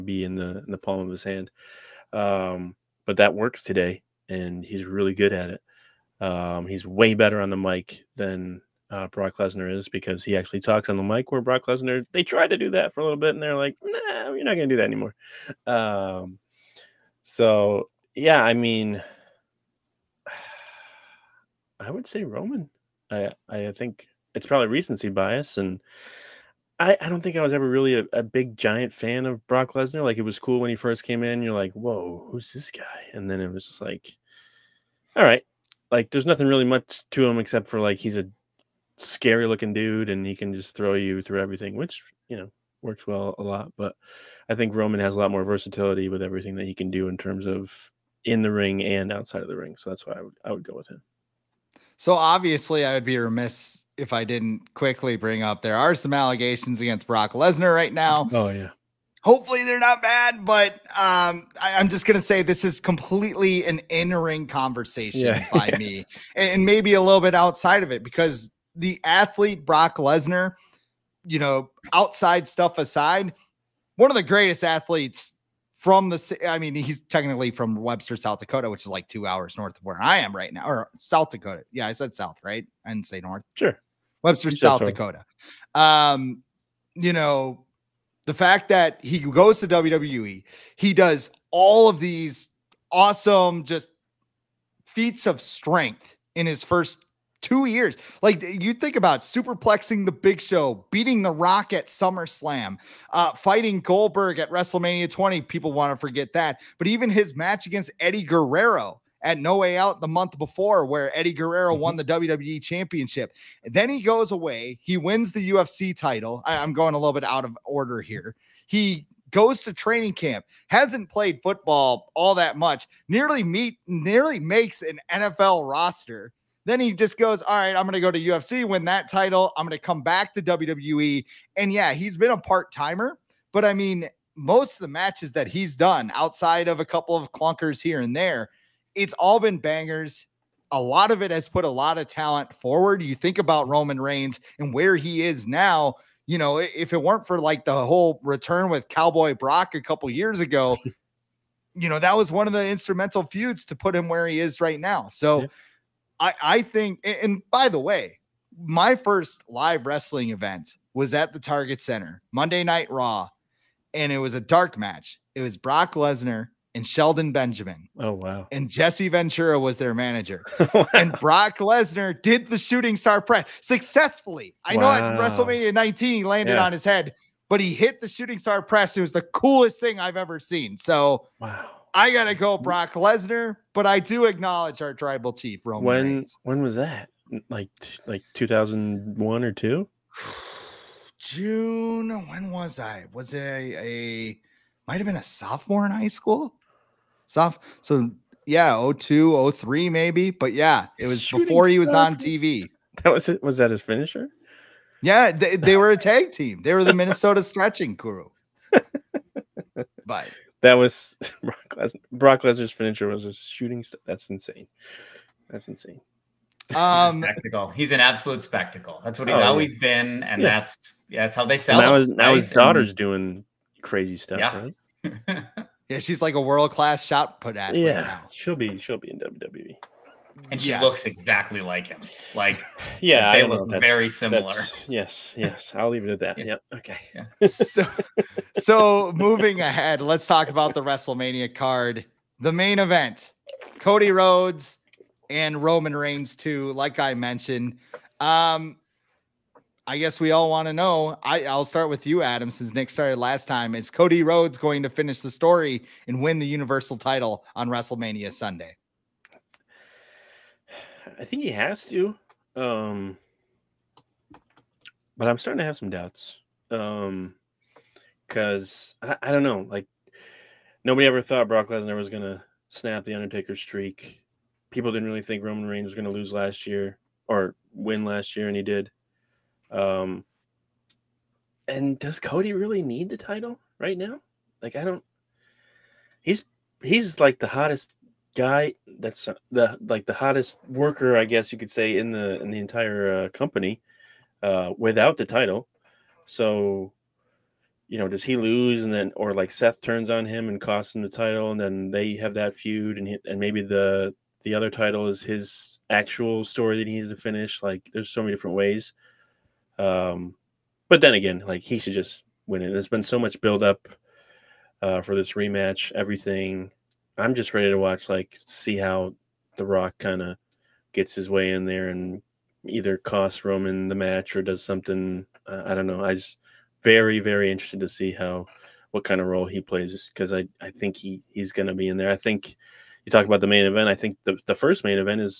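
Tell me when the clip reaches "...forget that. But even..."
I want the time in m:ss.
1:45.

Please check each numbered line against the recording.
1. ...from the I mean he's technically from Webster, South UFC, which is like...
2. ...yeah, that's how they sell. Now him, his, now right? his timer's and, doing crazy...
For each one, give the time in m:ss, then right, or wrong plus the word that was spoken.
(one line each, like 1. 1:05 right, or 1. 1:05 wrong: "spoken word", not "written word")
1. 1:15 wrong: "Dakota", not "UFC"
2. 3:41 wrong: "daughter", not "timer".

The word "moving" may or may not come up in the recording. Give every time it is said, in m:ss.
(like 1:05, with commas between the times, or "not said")
3:59.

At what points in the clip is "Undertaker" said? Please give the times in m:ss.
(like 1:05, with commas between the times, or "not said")
4:33.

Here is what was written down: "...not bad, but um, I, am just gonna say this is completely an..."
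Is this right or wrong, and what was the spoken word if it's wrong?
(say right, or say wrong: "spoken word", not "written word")
right.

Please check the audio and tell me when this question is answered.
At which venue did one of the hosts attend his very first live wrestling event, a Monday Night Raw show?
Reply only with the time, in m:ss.
2:41.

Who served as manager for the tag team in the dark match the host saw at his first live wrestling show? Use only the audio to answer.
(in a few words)
Jesse Ventura.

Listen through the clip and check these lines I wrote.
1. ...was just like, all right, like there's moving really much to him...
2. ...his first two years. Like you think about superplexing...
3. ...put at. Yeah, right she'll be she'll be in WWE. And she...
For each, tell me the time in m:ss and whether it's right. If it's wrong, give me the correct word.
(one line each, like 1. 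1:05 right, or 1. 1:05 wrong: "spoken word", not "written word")
1. 0:33 wrong: "nothing", not "moving"
2. 1:36 right
3. 3:47 right.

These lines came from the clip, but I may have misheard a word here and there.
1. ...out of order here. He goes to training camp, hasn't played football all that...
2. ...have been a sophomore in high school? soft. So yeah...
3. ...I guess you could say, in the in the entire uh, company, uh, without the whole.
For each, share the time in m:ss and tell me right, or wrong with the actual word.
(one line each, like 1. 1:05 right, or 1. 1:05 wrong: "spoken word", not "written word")
1. 1:57 right
2. 3:14 right
3. 4:51 wrong: "title", not "whole".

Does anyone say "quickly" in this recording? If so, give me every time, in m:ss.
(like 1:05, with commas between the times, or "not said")
0:54.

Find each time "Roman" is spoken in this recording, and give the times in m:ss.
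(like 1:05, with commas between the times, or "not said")
0:22, 0:44, 2:23, 3:05, 4:05, 4:35, 5:23.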